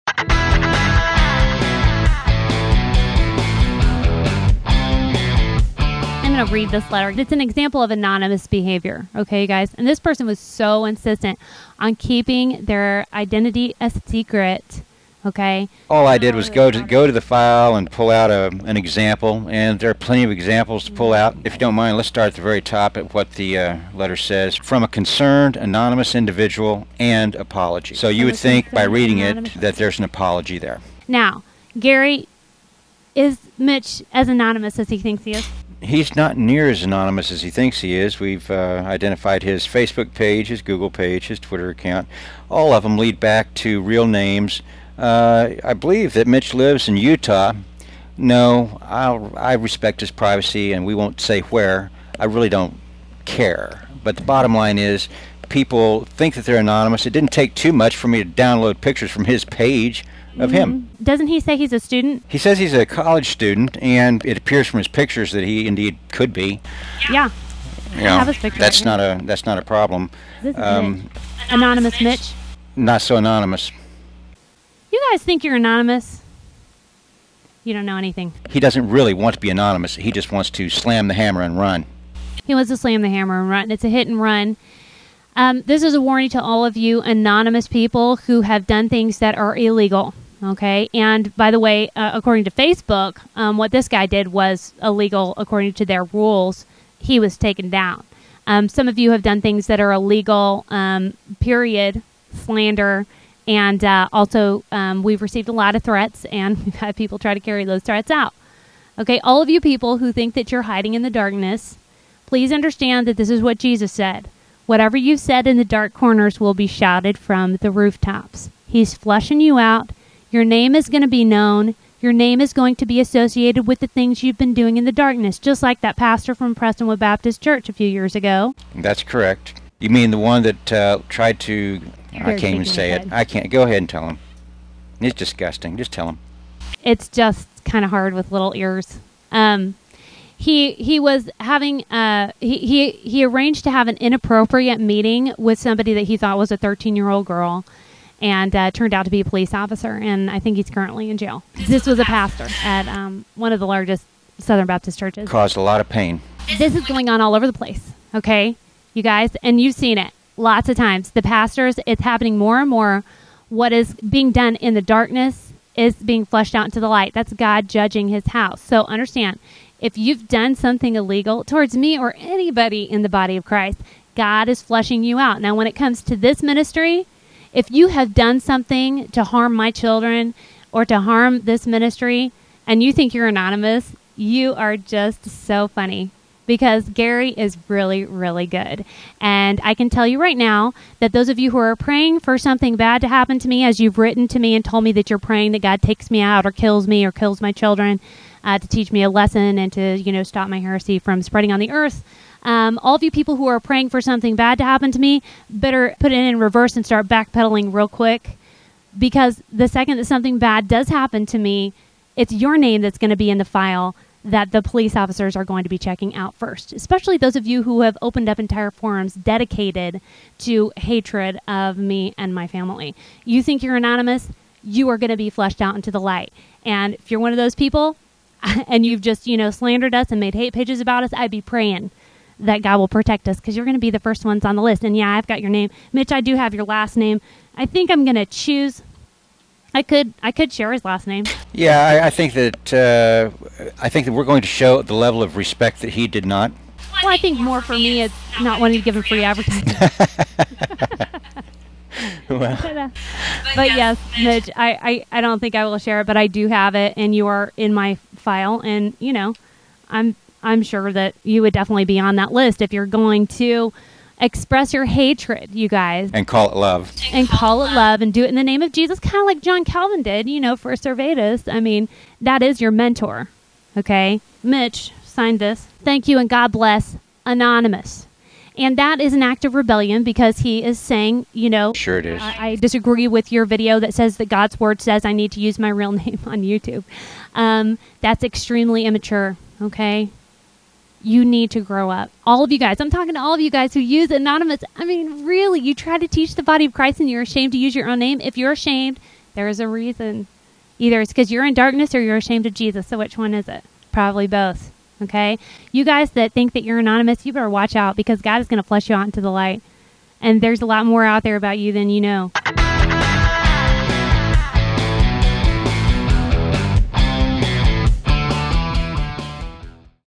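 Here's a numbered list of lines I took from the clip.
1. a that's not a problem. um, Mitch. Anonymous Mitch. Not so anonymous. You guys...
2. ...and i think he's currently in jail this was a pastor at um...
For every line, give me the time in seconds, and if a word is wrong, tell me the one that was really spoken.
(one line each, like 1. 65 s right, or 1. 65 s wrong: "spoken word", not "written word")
1. 69 s right
2. 150 s right.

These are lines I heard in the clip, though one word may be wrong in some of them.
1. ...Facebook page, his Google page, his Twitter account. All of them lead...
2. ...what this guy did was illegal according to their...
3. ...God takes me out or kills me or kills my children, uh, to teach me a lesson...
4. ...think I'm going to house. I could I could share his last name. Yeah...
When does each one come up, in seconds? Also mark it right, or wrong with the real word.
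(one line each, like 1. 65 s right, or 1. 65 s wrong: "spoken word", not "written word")
1. 39 s right
2. 93 s right
3. 195 s right
4. 237 s wrong: "choose", not "house".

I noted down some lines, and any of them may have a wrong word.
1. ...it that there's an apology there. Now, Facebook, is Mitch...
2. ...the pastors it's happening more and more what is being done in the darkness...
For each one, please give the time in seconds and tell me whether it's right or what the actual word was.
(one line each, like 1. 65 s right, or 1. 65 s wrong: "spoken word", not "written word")
1. 29 s wrong: "Gary", not "Facebook"
2. 161 s right.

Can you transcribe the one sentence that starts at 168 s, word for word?
So understand, if you've done something illegal towards me or anybody in the body of Christ, God is flushing you out.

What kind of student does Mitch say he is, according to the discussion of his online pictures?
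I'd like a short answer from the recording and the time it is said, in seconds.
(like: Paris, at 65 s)
College student, at 62 s.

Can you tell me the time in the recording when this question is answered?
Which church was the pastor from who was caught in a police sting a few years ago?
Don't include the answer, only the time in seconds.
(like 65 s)
126 s.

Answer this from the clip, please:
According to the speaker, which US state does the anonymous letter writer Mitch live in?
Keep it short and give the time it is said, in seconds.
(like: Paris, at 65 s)
Utah, at 46 s.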